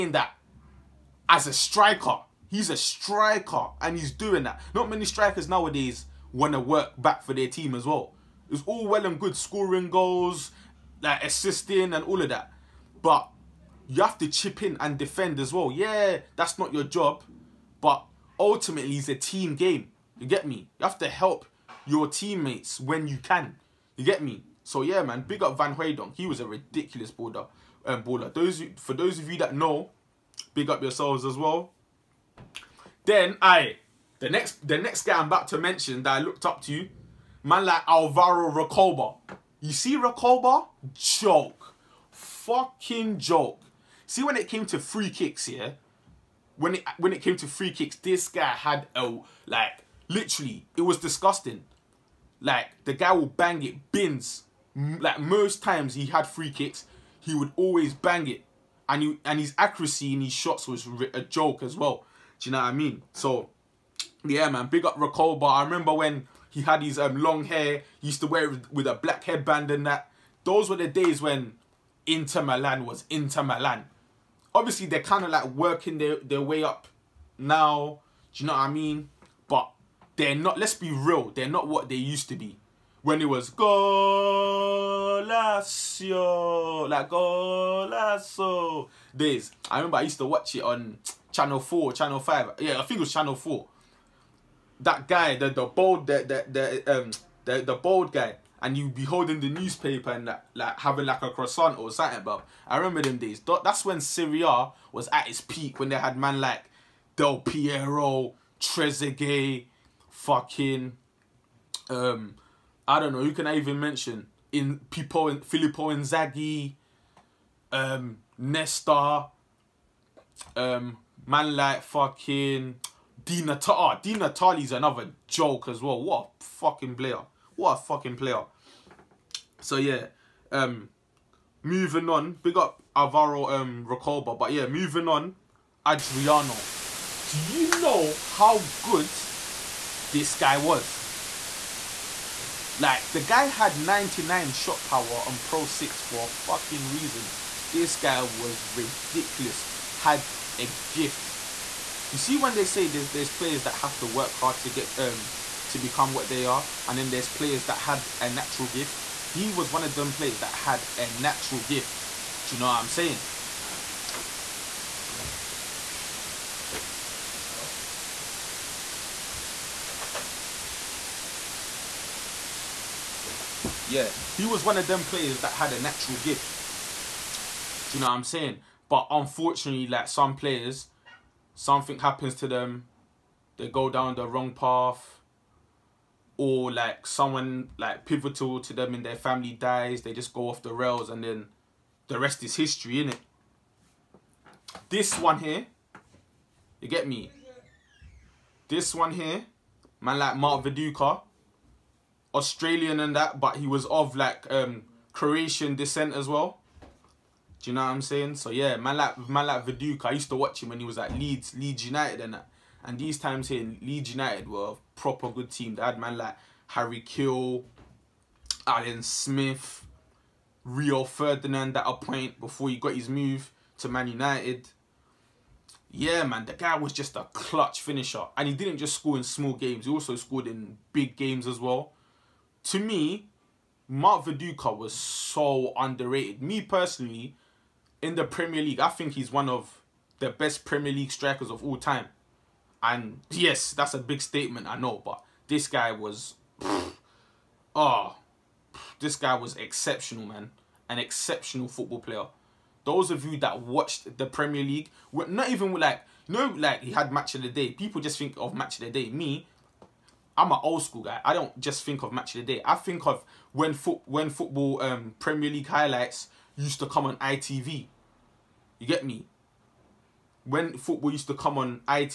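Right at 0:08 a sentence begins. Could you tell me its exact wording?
It's all well and good scoring goals, like assisting and all of that.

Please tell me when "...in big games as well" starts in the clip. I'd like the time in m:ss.
3:50.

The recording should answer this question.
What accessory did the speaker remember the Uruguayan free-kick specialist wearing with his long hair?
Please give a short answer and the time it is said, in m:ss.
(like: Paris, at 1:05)
Black headband, at 1:08.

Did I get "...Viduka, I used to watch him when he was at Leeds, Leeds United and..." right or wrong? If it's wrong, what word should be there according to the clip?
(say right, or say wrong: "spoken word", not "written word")
right.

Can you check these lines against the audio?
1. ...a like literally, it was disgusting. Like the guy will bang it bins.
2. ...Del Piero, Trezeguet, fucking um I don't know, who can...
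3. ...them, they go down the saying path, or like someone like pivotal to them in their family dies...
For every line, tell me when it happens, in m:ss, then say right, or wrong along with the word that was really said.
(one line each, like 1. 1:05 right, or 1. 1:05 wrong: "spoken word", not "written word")
1. 0:48 right
2. 1:47 right
3. 3:02 wrong: "wrong", not "saying".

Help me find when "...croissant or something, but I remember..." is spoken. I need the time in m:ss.
1:41.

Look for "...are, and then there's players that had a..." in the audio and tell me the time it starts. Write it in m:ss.
2:36.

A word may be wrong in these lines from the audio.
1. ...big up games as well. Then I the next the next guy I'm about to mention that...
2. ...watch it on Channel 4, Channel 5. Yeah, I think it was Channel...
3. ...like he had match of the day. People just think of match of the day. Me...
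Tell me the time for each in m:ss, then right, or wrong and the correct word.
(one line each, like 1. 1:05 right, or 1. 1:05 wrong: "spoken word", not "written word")
1. 0:30 wrong: "yourselves", not "games"
2. 1:30 right
3. 4:16 right.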